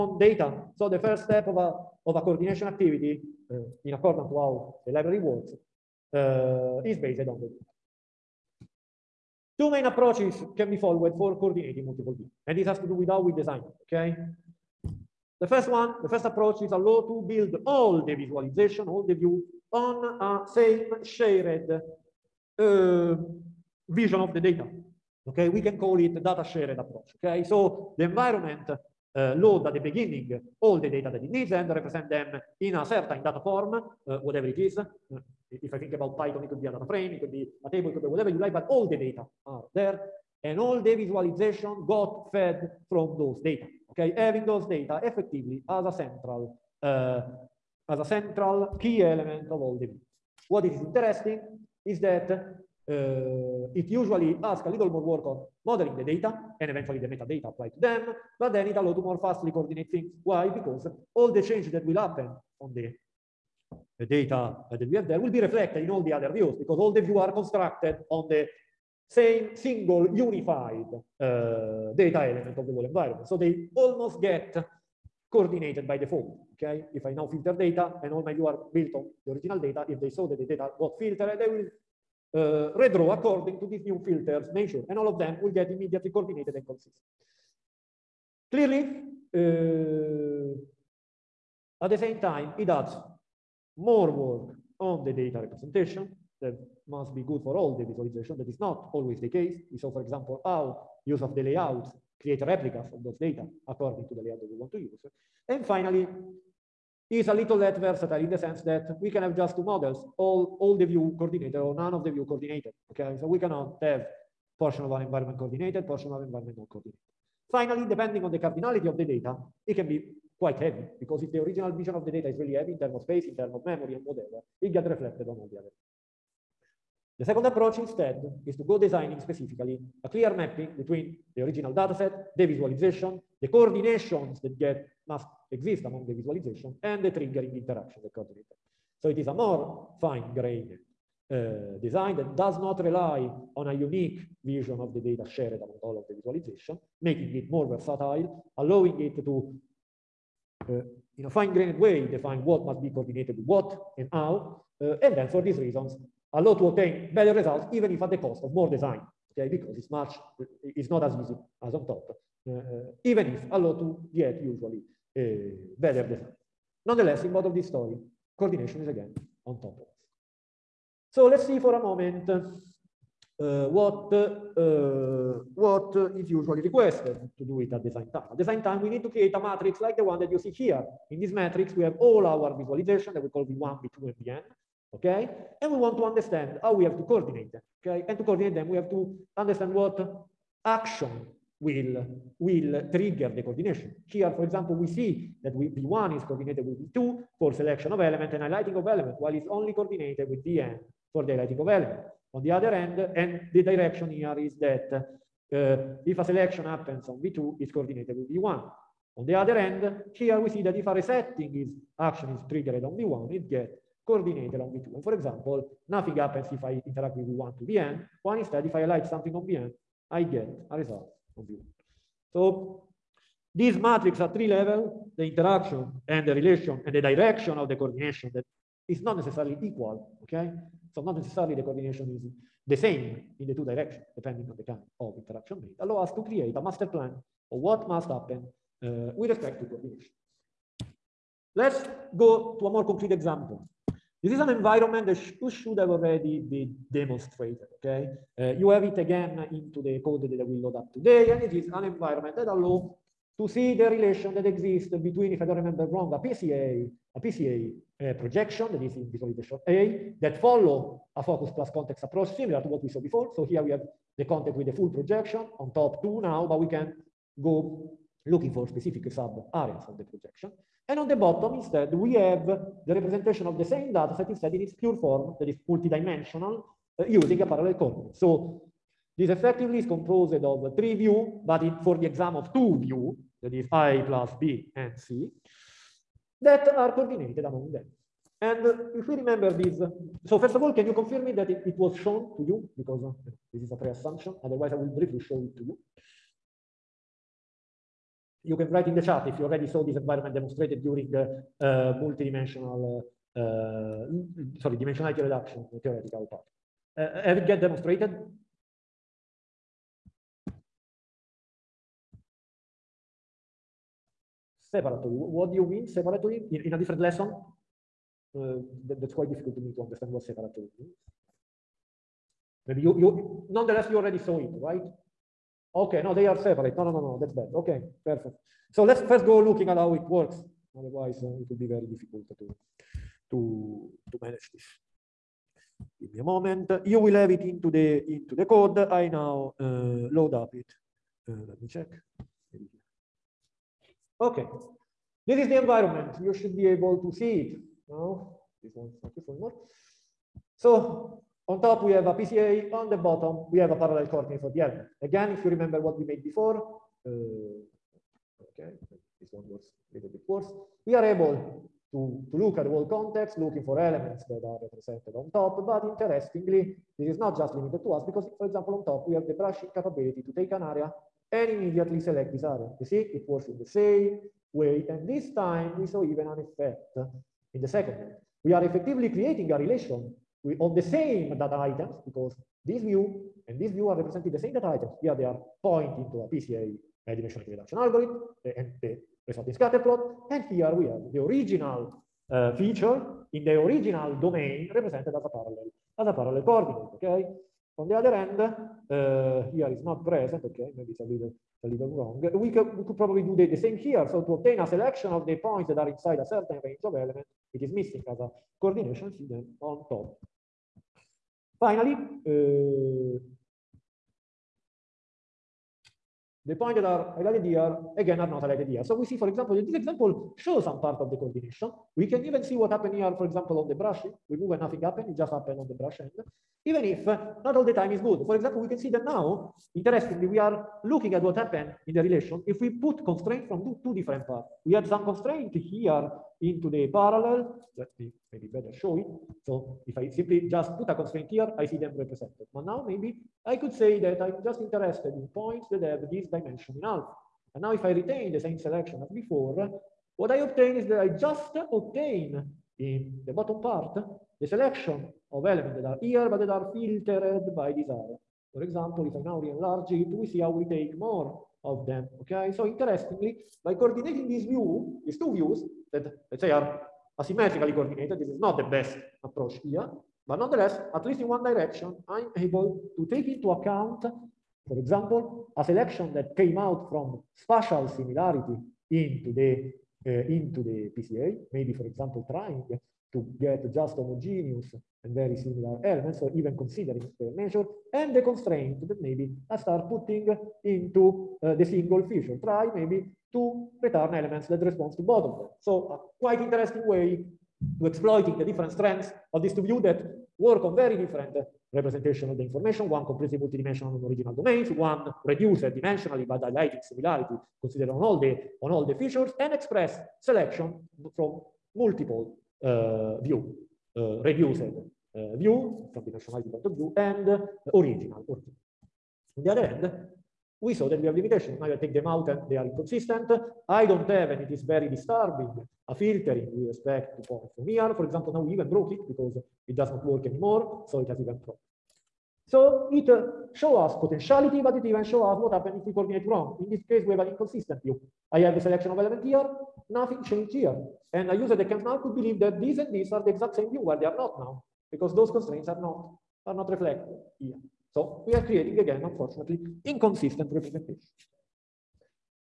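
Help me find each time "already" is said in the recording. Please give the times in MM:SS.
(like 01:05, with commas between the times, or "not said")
04:05, 04:59, 05:23.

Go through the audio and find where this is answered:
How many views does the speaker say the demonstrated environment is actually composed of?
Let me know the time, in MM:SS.
04:40.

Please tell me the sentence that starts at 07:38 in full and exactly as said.
For example, if I now re-enlarge it, we see how we take more of them, okay?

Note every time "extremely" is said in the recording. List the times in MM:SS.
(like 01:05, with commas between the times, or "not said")
not said.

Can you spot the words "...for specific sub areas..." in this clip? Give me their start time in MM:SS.
04:28.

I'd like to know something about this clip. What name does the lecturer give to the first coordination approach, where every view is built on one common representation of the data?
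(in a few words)
data shared approach.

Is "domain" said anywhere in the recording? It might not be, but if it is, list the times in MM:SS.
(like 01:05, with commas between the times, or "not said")
06:34, 08:24.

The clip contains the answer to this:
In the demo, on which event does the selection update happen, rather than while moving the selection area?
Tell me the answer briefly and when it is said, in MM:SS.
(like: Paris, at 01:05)
brush end, at 07:05.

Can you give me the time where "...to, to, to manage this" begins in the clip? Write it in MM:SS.
05:32.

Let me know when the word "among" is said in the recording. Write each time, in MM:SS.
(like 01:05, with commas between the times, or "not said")
02:15, 02:25, 04:47.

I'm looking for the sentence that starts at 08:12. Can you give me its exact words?
Try maybe to return elements that respond to both of them.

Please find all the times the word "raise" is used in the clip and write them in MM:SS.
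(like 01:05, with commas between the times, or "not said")
not said.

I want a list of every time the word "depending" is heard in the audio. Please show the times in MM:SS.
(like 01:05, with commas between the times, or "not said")
01:57, 03:54.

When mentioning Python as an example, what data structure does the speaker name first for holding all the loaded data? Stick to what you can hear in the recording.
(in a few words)
data frame.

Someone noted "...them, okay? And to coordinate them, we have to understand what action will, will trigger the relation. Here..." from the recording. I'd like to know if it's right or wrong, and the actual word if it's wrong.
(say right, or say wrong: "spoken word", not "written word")
wrong: "coordination", not "relation".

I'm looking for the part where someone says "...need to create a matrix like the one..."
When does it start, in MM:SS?
02:58.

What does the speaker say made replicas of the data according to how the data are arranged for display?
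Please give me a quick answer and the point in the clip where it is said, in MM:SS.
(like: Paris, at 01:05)
layouts, at 01:41.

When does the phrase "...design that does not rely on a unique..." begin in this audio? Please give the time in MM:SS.
02:21.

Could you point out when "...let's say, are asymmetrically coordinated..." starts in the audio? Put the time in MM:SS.
07:46.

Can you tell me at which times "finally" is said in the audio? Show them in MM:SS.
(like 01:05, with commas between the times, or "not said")
01:45, 01:57, 06:51.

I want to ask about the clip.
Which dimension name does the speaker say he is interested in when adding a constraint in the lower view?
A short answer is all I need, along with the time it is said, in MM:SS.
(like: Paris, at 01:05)
alpha, at 07:26.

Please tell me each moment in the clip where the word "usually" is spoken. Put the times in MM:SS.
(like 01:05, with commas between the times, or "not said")
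00:53, 02:44, 02:56.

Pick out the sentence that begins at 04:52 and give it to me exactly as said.
Because uh, this is a pre-assumption, otherwise I will briefly show it to you.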